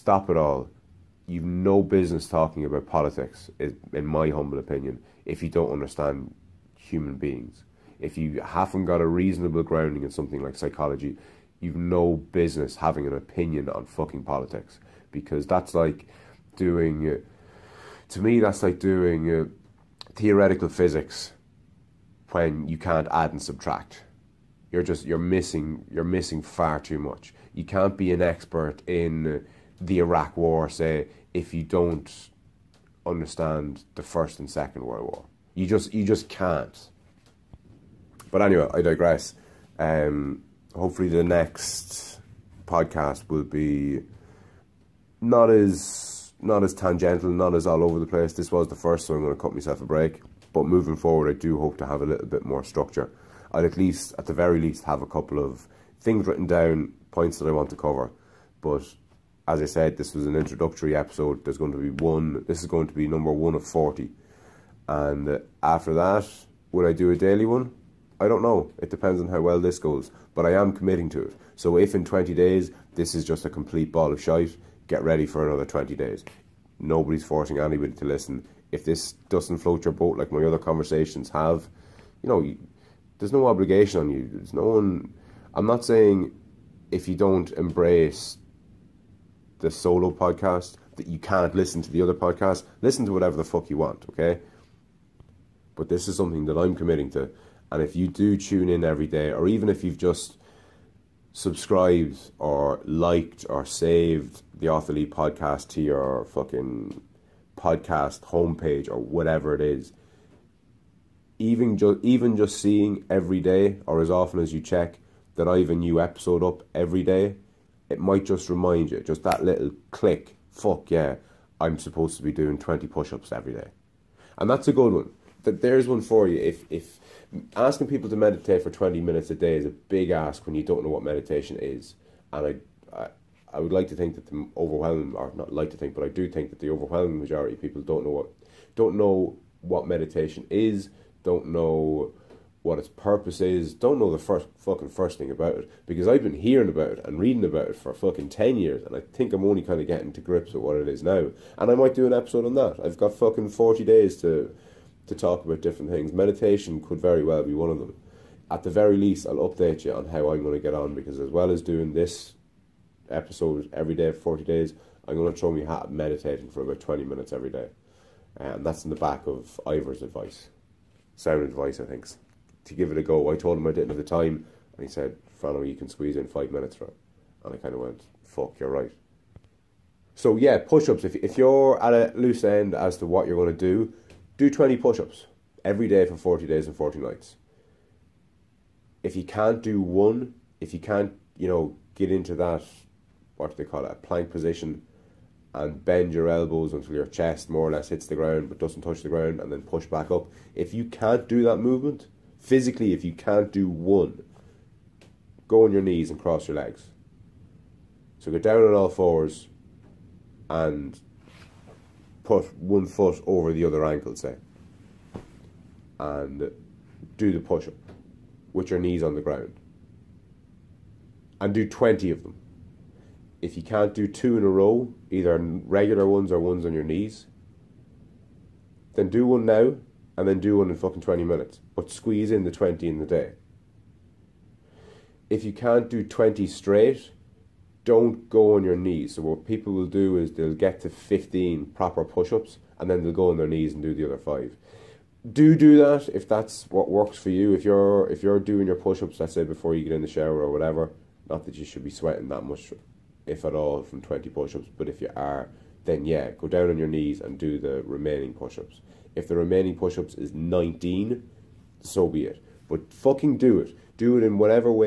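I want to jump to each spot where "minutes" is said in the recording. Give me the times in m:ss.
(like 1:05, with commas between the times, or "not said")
2:08, 2:47, 2:56, 3:51.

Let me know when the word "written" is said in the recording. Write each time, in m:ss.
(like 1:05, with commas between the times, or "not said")
0:56.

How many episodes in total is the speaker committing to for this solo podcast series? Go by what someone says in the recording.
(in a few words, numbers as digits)
40.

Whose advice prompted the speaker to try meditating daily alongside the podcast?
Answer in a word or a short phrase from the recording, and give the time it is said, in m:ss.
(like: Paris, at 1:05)
Ivor, at 2:49.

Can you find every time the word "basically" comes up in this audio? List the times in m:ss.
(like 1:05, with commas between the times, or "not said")
not said.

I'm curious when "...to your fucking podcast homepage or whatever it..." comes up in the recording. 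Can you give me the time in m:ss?
1:45.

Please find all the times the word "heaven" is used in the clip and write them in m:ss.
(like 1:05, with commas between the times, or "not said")
not said.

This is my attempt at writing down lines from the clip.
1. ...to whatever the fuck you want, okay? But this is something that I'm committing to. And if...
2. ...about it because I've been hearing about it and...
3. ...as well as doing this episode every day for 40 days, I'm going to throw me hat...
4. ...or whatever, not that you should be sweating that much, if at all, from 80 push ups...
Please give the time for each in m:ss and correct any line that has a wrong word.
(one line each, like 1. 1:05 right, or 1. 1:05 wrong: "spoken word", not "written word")
1. 1:33 right
2. 2:25 right
3. 2:41 right
4. 4:10 wrong: "20", not "80".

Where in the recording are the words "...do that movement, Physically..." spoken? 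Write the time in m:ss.
3:21.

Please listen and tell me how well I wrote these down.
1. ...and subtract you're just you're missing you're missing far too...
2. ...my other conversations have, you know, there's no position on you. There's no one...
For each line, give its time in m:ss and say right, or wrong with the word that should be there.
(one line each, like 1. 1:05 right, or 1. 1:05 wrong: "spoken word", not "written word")
1. 0:23 right
2. 1:20 wrong: "obligation", not "position".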